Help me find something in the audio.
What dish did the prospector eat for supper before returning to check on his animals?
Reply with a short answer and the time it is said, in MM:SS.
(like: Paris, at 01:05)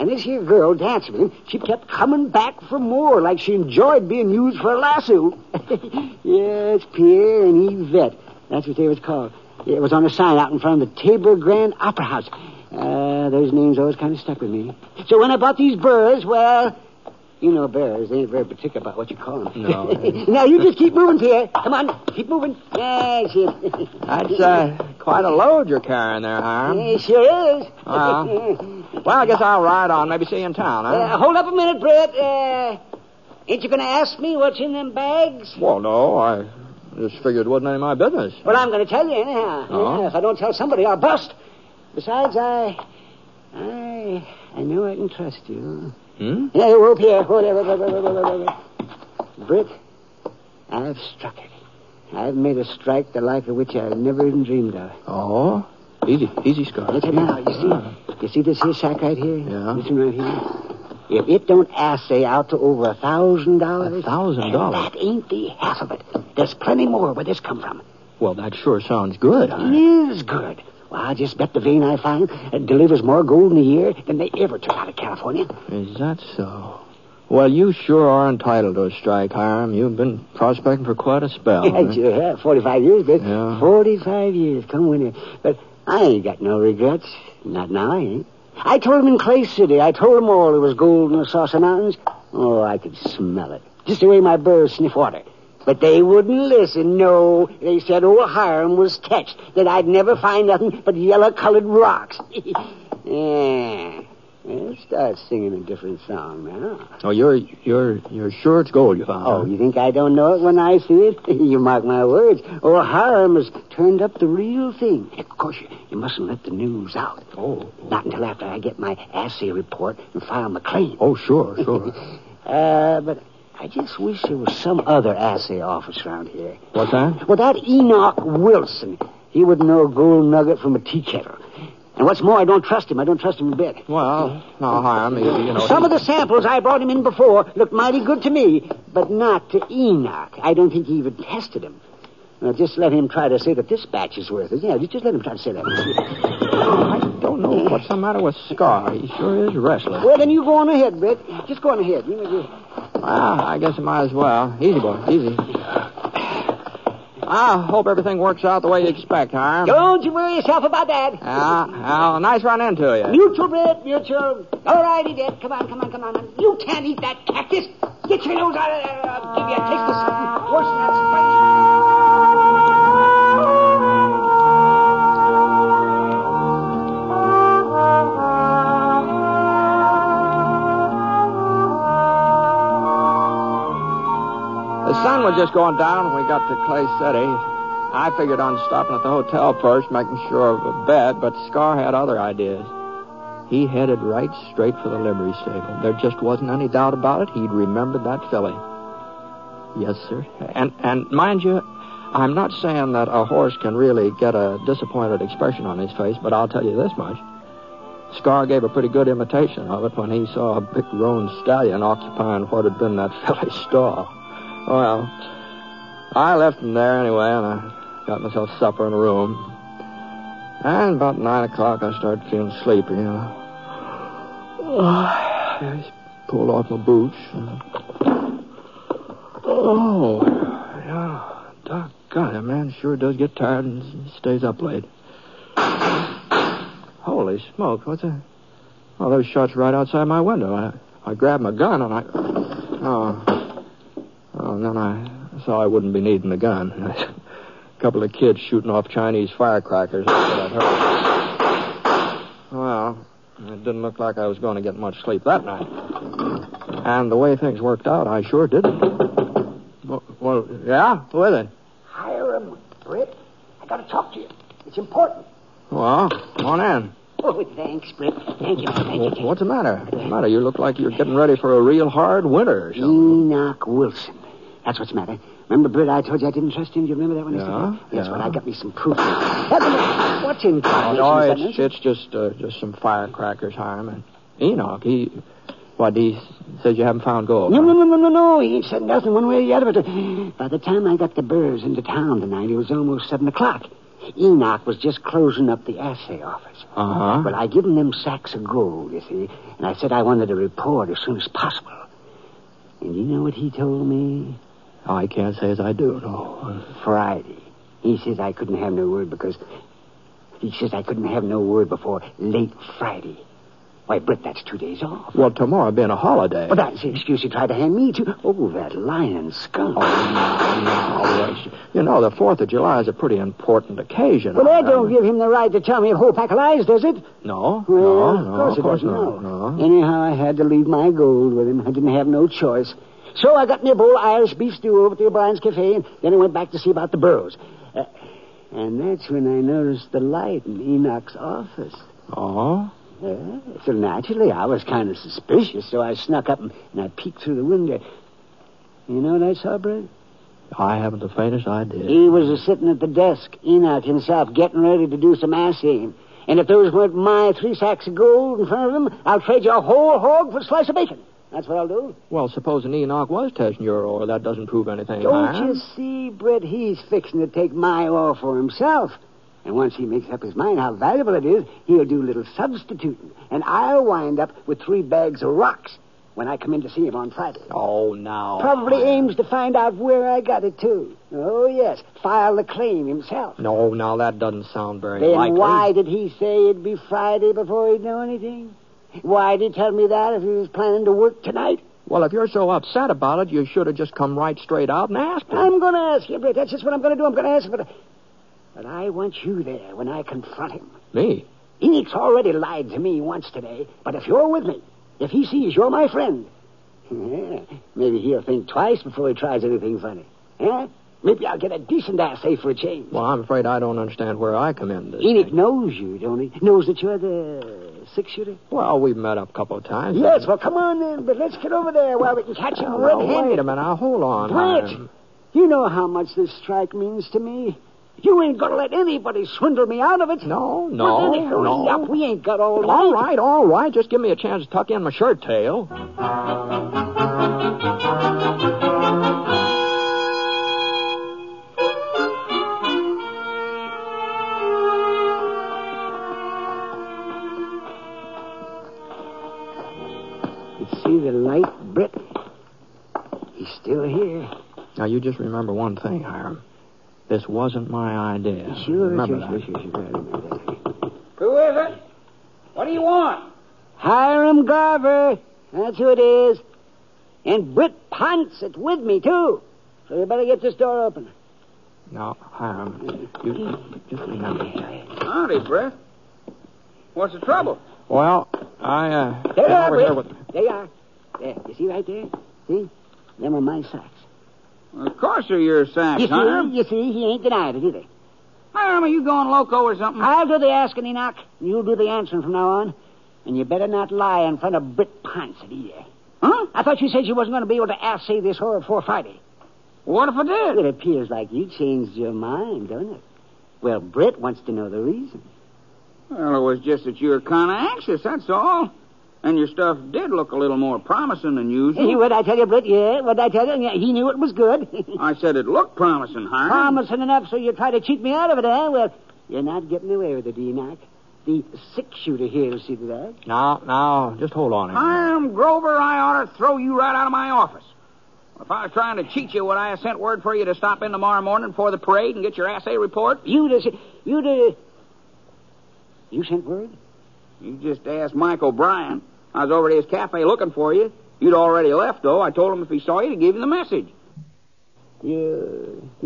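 Irish beef stew, at 05:34.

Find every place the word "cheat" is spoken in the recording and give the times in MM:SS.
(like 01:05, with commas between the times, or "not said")
08:37, 08:49.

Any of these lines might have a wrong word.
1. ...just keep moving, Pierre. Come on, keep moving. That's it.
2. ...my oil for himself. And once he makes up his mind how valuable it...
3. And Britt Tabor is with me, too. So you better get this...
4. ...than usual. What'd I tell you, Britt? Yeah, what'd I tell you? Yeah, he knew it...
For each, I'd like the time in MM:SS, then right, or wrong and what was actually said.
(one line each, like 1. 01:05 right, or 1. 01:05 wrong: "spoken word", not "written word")
1. 00:20 right
2. 06:07 right
3. 07:47 wrong: "Ponset", not "Tabor"
4. 08:31 right.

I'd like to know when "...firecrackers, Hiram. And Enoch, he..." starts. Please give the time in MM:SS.
04:42.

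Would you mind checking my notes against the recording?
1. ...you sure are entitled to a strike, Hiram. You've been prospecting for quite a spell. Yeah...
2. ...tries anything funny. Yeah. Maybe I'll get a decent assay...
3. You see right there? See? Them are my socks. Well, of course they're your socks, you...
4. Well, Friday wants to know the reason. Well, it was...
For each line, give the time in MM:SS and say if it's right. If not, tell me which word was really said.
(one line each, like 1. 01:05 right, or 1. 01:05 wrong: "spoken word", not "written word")
1. 01:17 right
2. 06:49 right
3. 08:01 right
4. 08:23 wrong: "Britt", not "Friday".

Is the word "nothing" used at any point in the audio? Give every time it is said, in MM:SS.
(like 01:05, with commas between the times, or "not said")
01:40, 04:48.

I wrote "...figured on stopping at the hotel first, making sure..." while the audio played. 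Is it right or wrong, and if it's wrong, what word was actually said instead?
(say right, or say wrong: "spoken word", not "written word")
right.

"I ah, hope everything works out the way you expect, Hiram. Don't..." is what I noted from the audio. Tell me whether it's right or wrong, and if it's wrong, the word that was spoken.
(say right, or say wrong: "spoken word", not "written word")
right.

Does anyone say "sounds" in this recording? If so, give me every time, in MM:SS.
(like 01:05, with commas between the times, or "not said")
01:08, 06:24.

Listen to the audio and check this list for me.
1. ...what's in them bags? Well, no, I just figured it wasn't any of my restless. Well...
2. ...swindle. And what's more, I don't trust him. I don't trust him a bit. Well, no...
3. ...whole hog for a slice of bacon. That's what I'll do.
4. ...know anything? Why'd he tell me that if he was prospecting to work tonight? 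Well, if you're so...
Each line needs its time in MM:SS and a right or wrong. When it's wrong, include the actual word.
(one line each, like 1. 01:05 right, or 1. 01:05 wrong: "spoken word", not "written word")
1. 00:34 wrong: "business", not "restless"
2. 02:11 wrong: "kettle", not "swindle"
3. 05:59 right
4. 06:27 wrong: "planning", not "prospecting".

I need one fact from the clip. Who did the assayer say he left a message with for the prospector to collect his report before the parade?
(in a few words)
Mike O'Brien.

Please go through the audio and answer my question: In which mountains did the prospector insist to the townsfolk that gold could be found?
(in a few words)
Saucer Mountains.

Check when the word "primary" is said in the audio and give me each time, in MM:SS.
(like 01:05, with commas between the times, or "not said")
not said.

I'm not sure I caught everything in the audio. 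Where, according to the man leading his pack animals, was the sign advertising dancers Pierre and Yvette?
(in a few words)
Tabor Grand Opera House.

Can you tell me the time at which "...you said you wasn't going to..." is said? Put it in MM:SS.
08:16.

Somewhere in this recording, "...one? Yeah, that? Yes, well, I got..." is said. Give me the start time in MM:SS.
04:37.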